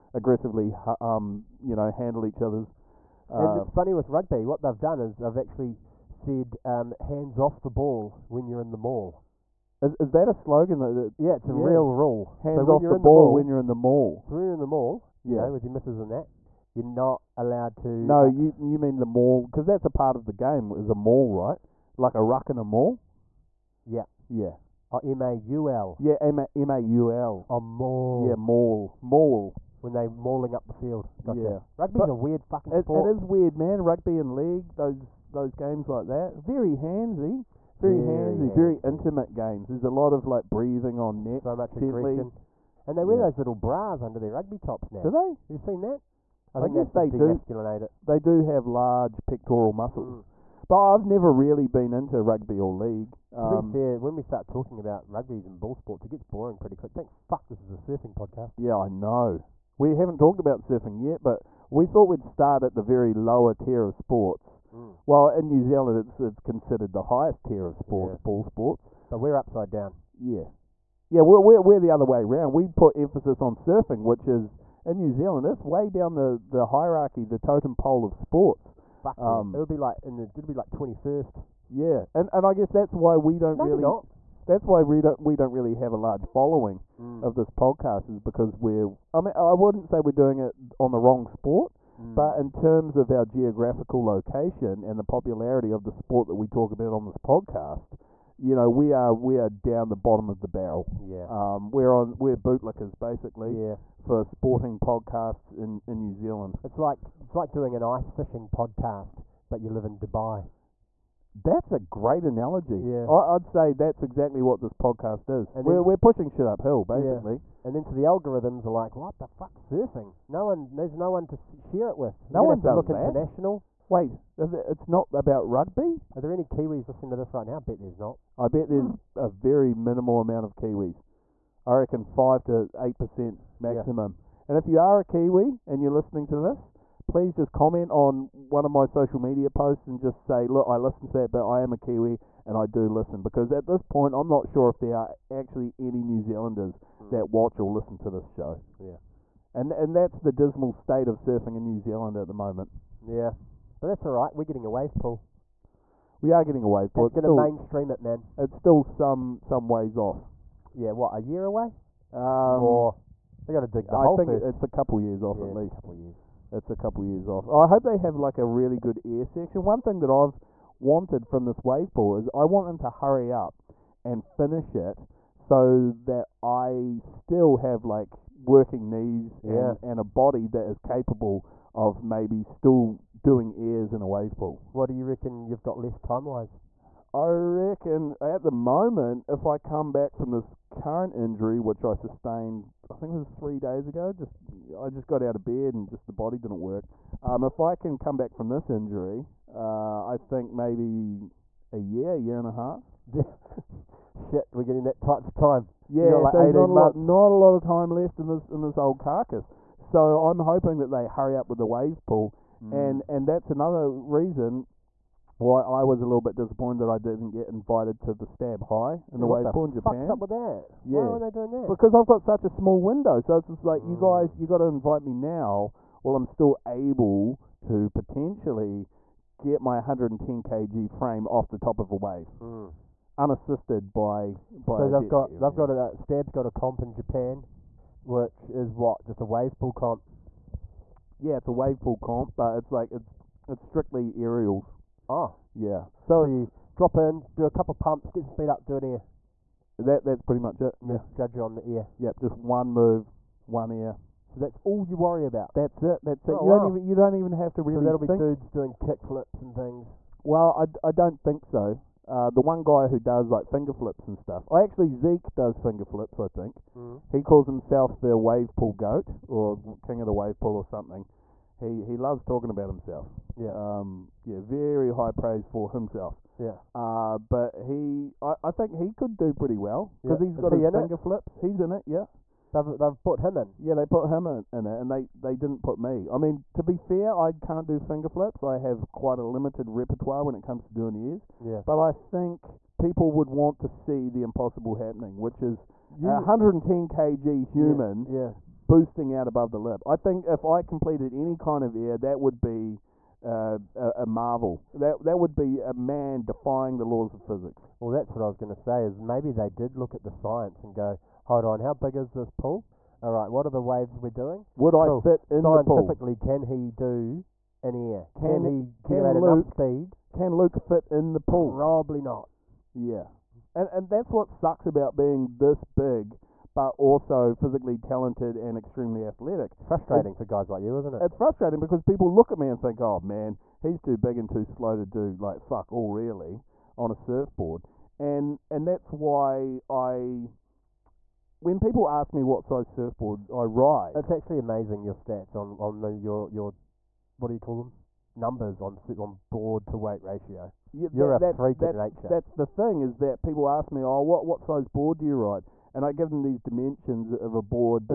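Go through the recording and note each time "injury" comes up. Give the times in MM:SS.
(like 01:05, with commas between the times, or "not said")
03:11, 03:18.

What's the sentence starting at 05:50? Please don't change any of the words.
Yeah, You're that, a that's, freak that's, nature.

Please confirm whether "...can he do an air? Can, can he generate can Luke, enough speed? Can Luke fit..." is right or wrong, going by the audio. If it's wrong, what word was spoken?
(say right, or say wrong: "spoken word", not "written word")
right.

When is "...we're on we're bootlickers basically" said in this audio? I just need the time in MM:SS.
01:41.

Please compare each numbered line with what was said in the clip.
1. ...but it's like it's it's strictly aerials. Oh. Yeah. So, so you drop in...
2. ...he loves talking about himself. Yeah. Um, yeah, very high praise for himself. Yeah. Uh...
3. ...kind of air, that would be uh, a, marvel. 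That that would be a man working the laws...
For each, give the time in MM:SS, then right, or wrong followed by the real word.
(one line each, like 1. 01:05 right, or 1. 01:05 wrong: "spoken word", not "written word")
1. 04:02 right
2. 04:31 right
3. 05:01 wrong: "defying", not "working".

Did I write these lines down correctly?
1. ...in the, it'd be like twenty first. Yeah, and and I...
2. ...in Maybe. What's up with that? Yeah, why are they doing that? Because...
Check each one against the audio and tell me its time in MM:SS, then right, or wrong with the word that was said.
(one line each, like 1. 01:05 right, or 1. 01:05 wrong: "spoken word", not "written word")
1. 01:20 right
2. 03:39 wrong: "Japan", not "Maybe".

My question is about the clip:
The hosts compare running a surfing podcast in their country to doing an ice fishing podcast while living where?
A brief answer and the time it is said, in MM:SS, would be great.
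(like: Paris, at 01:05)
Dubai, at 01:49.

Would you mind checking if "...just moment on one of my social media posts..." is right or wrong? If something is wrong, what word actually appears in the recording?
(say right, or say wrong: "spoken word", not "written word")
wrong: "comment", not "moment".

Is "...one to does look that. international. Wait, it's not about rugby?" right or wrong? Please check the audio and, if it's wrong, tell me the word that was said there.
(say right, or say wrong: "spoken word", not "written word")
right.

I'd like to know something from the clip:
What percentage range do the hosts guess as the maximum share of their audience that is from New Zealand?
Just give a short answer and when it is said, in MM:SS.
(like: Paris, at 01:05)
5 to 8%, at 02:12.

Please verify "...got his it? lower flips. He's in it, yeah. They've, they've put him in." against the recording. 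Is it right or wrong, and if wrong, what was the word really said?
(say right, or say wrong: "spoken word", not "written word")
wrong: "finger", not "lower".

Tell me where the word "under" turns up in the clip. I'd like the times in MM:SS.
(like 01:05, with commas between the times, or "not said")
00:44.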